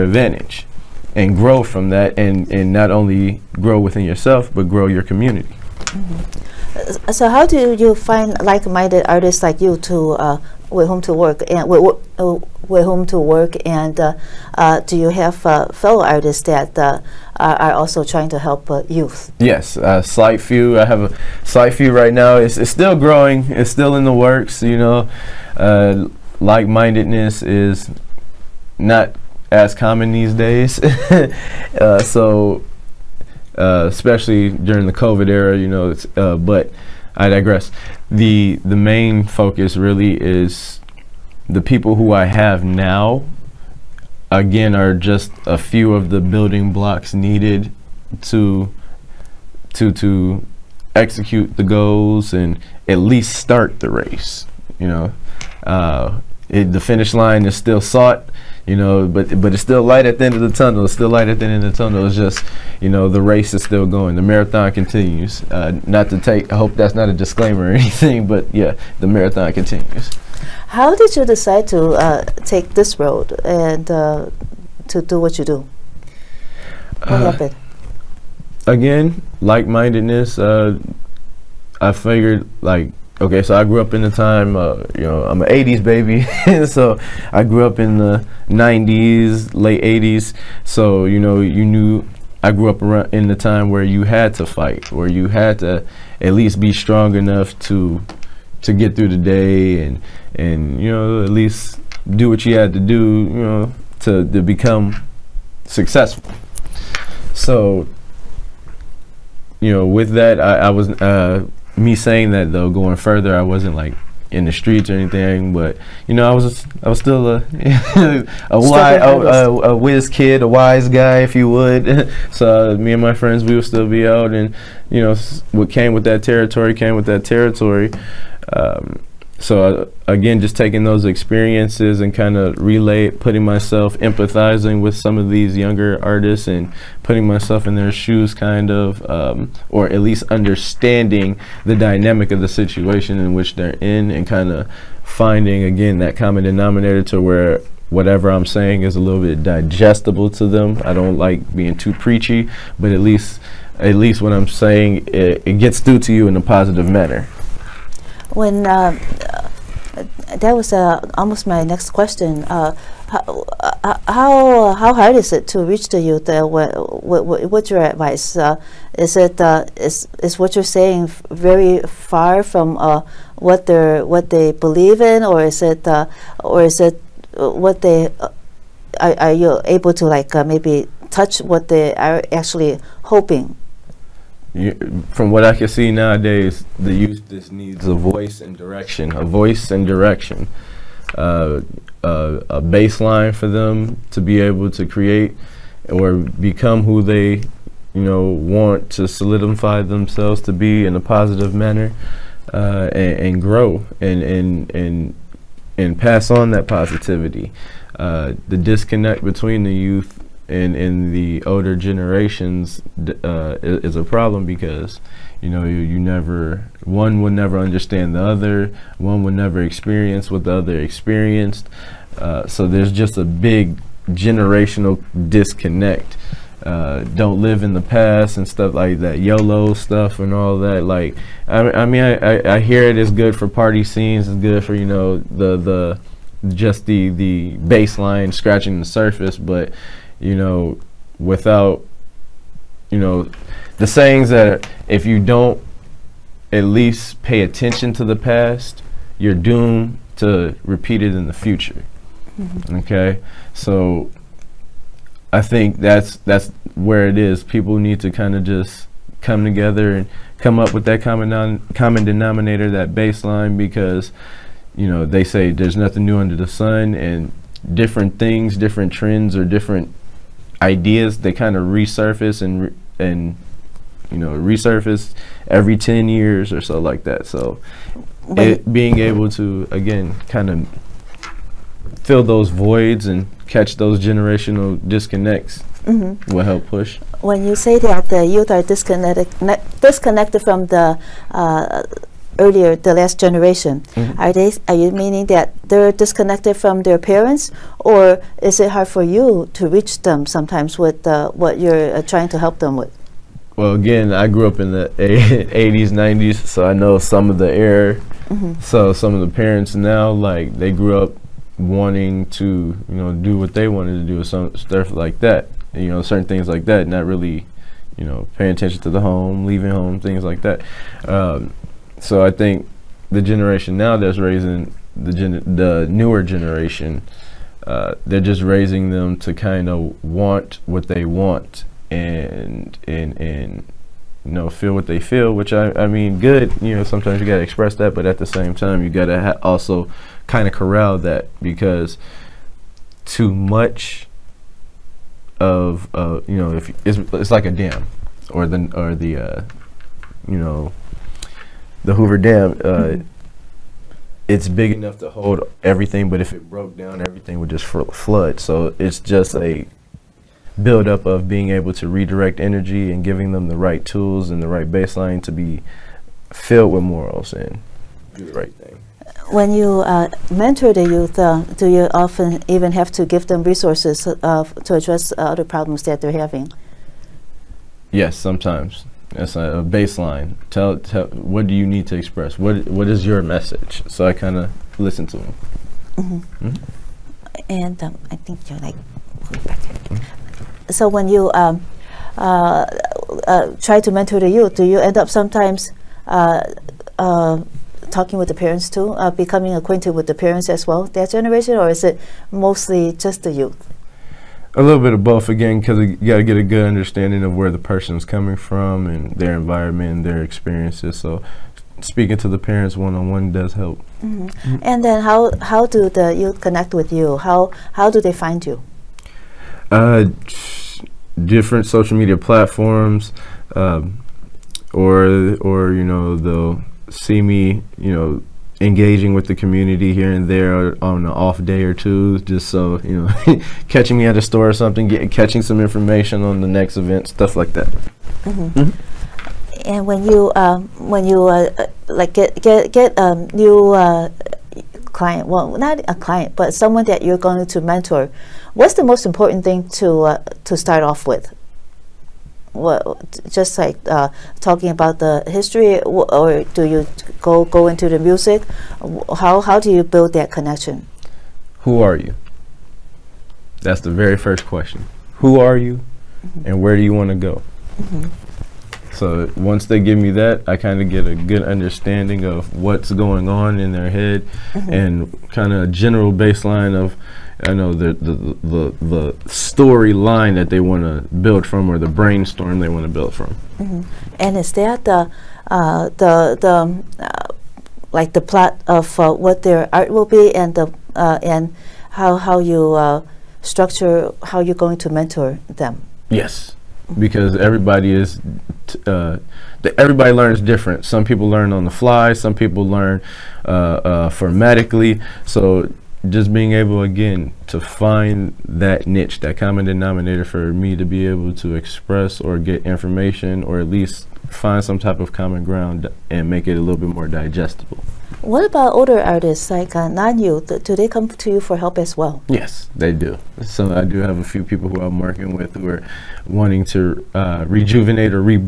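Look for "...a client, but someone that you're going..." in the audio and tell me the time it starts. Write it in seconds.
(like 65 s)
445 s.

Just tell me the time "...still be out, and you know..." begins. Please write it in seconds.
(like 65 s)
123 s.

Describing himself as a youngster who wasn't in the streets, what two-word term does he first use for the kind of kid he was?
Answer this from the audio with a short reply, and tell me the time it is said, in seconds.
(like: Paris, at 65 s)
whiz kid, at 119 s.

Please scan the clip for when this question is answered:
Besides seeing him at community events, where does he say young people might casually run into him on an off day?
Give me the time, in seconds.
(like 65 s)
434 s.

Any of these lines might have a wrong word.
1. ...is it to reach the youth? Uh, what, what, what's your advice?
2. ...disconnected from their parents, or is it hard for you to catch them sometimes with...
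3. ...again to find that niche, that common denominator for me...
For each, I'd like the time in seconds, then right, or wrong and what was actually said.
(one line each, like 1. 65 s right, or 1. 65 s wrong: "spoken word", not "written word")
1. 165 s right
2. 295 s wrong: "reach", not "catch"
3. 506 s right.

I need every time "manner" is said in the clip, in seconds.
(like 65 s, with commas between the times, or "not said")
156 s, 201 s.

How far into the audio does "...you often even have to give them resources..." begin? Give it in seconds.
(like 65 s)
371 s.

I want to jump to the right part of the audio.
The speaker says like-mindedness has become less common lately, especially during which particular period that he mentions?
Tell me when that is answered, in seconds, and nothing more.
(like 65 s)
34 s.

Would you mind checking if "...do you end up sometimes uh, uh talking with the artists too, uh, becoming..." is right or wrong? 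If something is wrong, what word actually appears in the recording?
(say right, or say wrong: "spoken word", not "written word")
wrong: "parents", not "artists".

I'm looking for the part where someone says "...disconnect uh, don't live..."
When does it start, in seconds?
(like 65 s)
225 s.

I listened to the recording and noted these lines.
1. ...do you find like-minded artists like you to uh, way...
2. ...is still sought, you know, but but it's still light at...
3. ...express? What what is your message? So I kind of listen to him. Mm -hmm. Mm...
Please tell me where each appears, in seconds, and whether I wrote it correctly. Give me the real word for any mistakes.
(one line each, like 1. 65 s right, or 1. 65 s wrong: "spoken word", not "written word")
1. 7 s right
2. 57 s right
3. 381 s right.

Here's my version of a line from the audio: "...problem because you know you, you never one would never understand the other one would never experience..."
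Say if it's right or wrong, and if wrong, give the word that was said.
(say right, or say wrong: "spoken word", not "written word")
right.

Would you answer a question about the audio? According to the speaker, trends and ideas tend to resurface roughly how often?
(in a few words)
every 10 years.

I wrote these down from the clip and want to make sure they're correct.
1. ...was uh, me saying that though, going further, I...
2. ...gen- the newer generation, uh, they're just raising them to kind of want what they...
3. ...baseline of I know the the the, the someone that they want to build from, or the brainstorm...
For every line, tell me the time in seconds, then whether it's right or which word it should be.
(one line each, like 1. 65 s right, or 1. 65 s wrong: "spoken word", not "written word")
1. 110 s right
2. 325 s right
3. 476 s wrong: "storyline", not "someone".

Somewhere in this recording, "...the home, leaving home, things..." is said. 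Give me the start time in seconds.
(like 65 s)
318 s.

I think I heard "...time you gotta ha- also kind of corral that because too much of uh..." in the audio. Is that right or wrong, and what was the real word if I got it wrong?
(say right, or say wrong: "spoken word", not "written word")
right.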